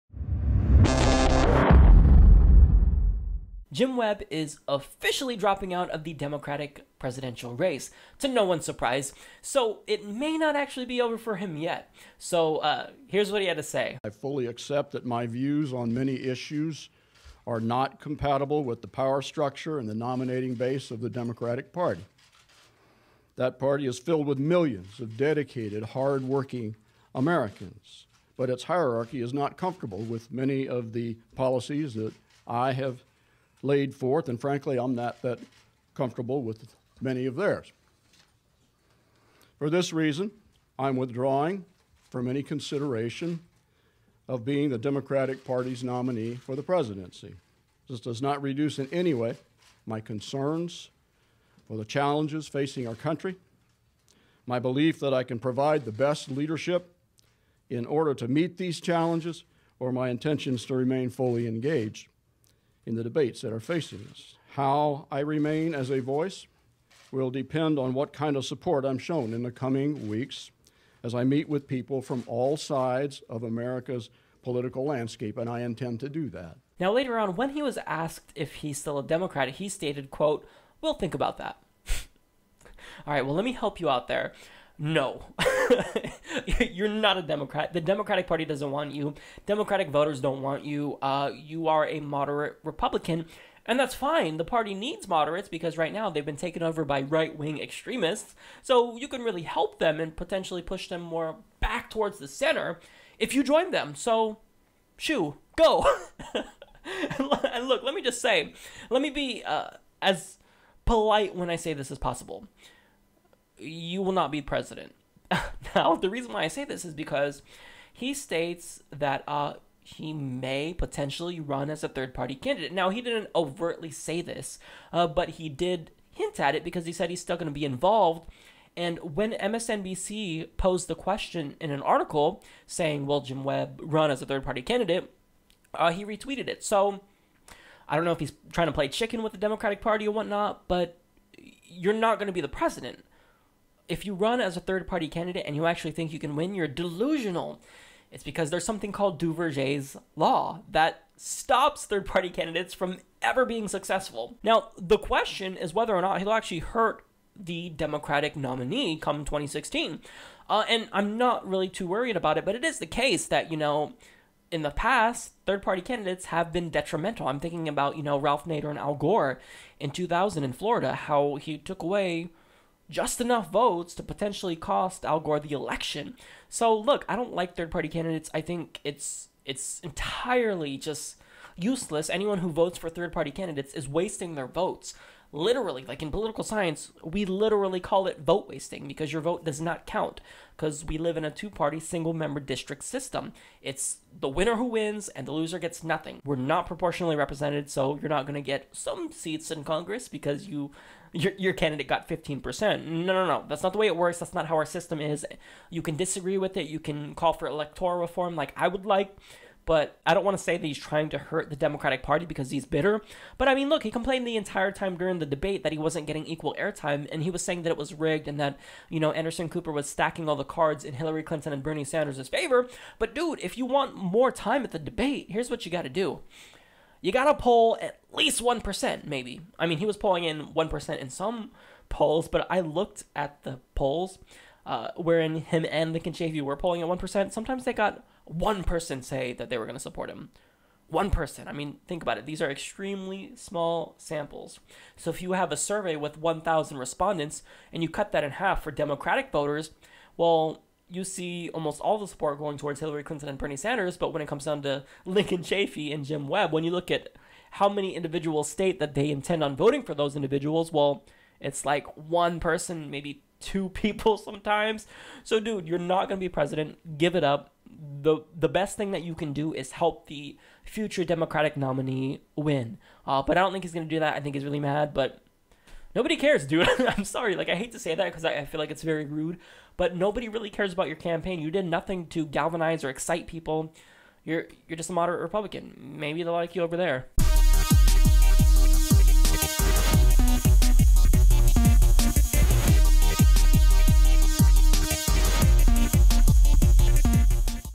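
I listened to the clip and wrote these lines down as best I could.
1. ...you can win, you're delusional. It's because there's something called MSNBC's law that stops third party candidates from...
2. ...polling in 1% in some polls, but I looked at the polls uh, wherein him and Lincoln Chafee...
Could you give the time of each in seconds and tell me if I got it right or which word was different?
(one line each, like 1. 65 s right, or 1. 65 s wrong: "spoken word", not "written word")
1. 146 s wrong: "Duverger", not "MSNBC"
2. 229 s right.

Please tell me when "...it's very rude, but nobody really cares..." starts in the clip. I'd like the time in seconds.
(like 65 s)
278 s.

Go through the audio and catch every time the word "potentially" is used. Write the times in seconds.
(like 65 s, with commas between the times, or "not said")
100 s, 120 s, 174 s.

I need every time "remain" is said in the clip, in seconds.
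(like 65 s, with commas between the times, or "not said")
60 s, 65 s.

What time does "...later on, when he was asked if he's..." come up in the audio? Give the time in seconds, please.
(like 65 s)
76 s.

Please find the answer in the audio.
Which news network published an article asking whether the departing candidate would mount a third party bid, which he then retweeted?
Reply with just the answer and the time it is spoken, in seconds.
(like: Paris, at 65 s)
MSNBC, at 129 s.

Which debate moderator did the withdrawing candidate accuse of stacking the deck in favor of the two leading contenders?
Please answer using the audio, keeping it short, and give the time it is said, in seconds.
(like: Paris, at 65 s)
Anderson Cooper, at 219 s.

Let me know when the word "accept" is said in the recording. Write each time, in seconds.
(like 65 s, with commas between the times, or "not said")
14 s.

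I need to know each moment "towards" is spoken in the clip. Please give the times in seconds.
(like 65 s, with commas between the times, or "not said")
101 s, 252 s.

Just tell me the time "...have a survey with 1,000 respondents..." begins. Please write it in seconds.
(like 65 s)
245 s.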